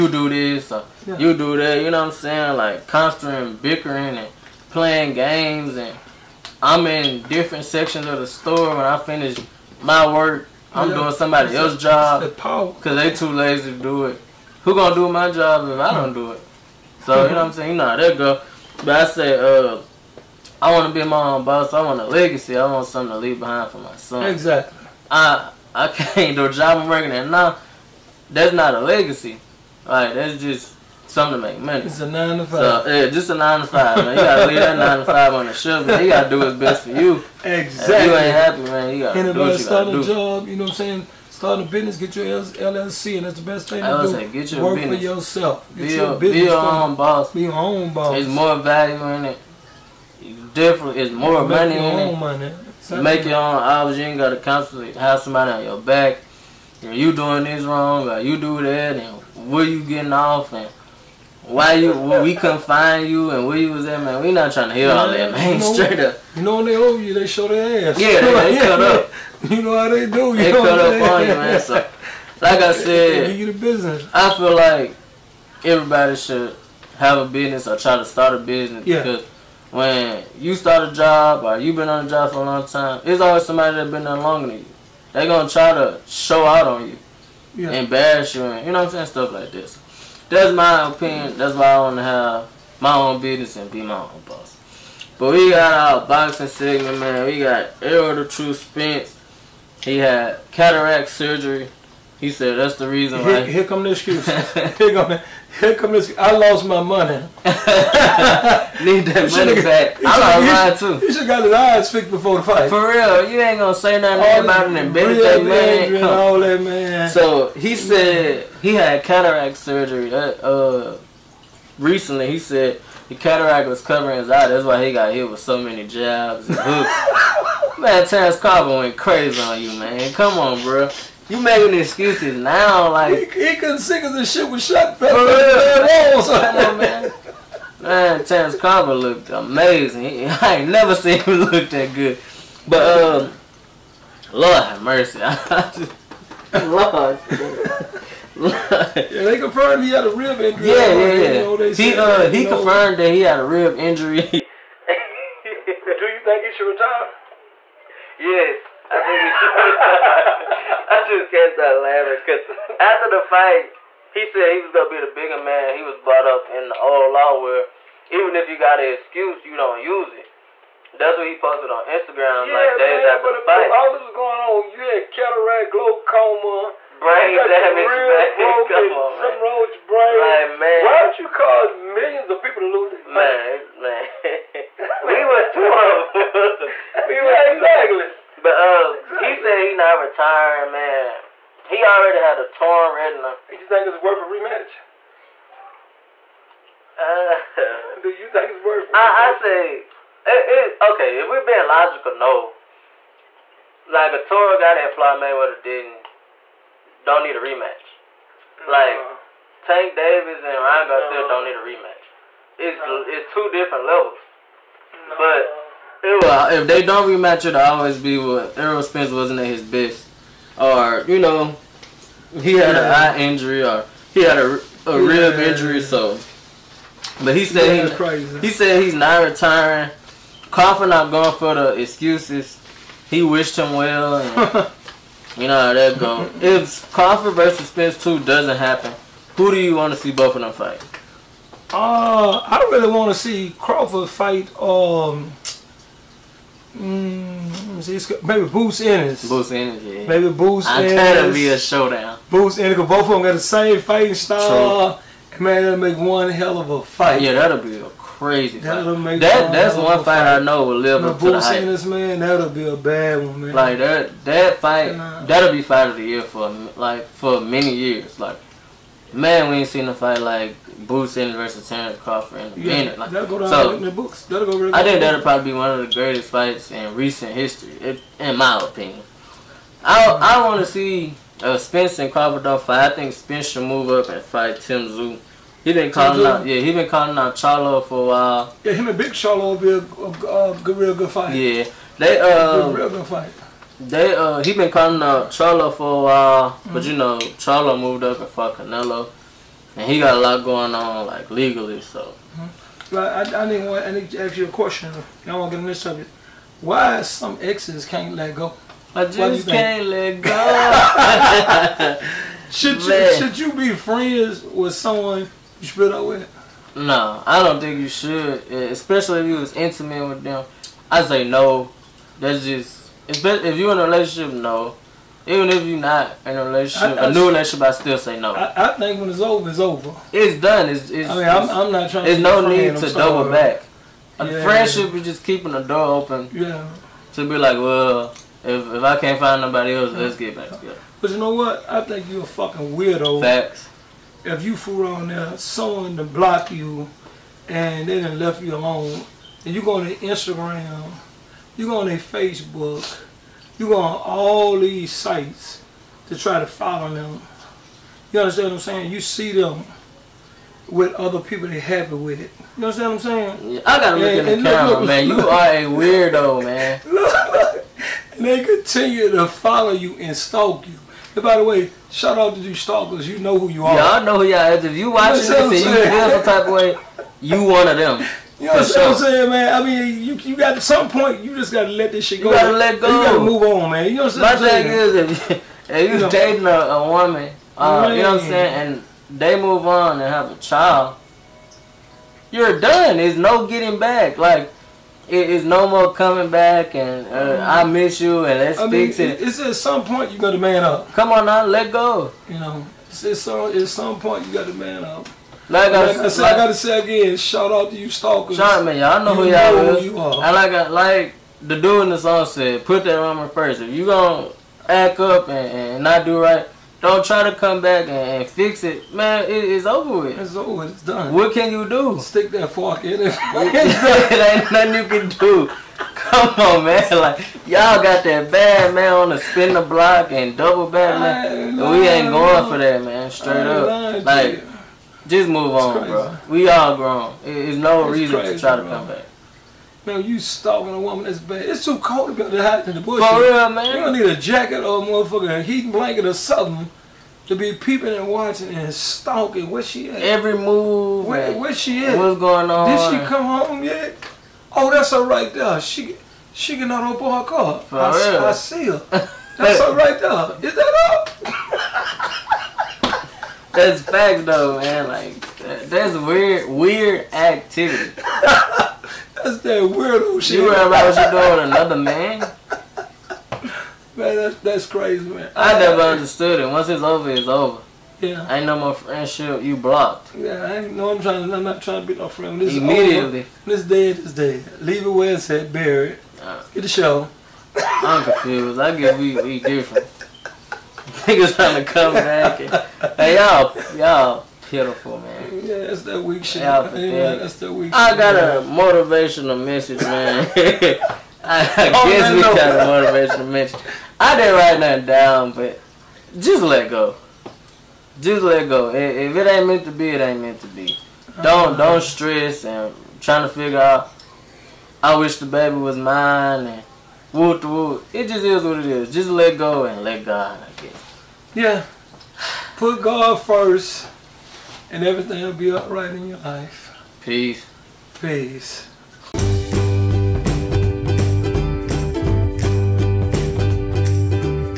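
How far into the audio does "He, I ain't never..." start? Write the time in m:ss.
2:20.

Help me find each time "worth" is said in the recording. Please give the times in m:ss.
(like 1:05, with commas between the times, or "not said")
3:14, 3:18.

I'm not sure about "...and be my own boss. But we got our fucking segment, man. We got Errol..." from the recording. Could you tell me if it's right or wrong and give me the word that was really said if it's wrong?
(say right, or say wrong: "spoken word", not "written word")
wrong: "boxing", not "fucking".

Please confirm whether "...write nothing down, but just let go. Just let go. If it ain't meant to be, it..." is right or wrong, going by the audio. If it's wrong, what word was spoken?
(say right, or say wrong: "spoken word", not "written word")
right.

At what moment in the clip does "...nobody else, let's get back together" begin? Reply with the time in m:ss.
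5:39.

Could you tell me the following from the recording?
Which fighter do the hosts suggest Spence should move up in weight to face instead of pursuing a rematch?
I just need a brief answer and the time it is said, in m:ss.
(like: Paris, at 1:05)
Tim Tszyu, at 4:44.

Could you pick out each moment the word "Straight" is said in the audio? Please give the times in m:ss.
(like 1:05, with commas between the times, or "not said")
1:05, 7:13.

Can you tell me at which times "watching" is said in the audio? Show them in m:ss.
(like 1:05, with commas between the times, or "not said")
6:14, 7:28.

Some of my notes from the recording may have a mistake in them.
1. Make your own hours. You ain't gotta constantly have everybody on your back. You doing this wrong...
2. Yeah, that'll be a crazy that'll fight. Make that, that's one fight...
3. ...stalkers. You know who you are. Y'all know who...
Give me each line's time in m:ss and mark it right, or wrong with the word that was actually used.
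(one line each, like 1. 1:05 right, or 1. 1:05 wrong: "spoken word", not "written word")
1. 0:53 wrong: "somebody", not "everybody"
2. 4:17 right
3. 6:12 right.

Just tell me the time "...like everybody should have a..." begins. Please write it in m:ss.
1:14.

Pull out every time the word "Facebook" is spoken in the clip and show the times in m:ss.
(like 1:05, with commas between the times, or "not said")
5:51.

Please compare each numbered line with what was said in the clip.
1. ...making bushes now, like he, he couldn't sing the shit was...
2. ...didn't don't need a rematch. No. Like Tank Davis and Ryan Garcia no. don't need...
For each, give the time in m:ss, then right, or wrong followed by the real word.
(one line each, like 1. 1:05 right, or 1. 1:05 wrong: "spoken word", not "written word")
1. 2:11 wrong: "excuses", not "bushes"
2. 3:25 right.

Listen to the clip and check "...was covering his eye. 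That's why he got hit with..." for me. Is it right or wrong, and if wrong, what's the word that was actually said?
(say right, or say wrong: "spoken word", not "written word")
right.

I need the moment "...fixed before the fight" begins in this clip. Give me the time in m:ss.
1:51.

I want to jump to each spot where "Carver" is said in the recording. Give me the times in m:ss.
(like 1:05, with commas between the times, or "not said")
2:08.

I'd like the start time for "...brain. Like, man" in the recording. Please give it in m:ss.
2:59.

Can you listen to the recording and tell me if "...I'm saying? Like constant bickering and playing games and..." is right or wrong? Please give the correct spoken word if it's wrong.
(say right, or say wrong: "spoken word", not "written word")
right.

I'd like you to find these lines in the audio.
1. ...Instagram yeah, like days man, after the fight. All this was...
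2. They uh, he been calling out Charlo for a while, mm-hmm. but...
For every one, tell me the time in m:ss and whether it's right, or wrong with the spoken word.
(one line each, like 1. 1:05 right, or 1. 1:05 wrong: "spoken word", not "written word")
1. 2:51 right
2. 4:53 right.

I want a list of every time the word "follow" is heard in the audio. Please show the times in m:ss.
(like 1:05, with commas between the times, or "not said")
5:56, 6:09.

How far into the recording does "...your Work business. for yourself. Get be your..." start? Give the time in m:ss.
0:44.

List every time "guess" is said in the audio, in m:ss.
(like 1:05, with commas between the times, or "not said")
8:08, 8:21, 8:40.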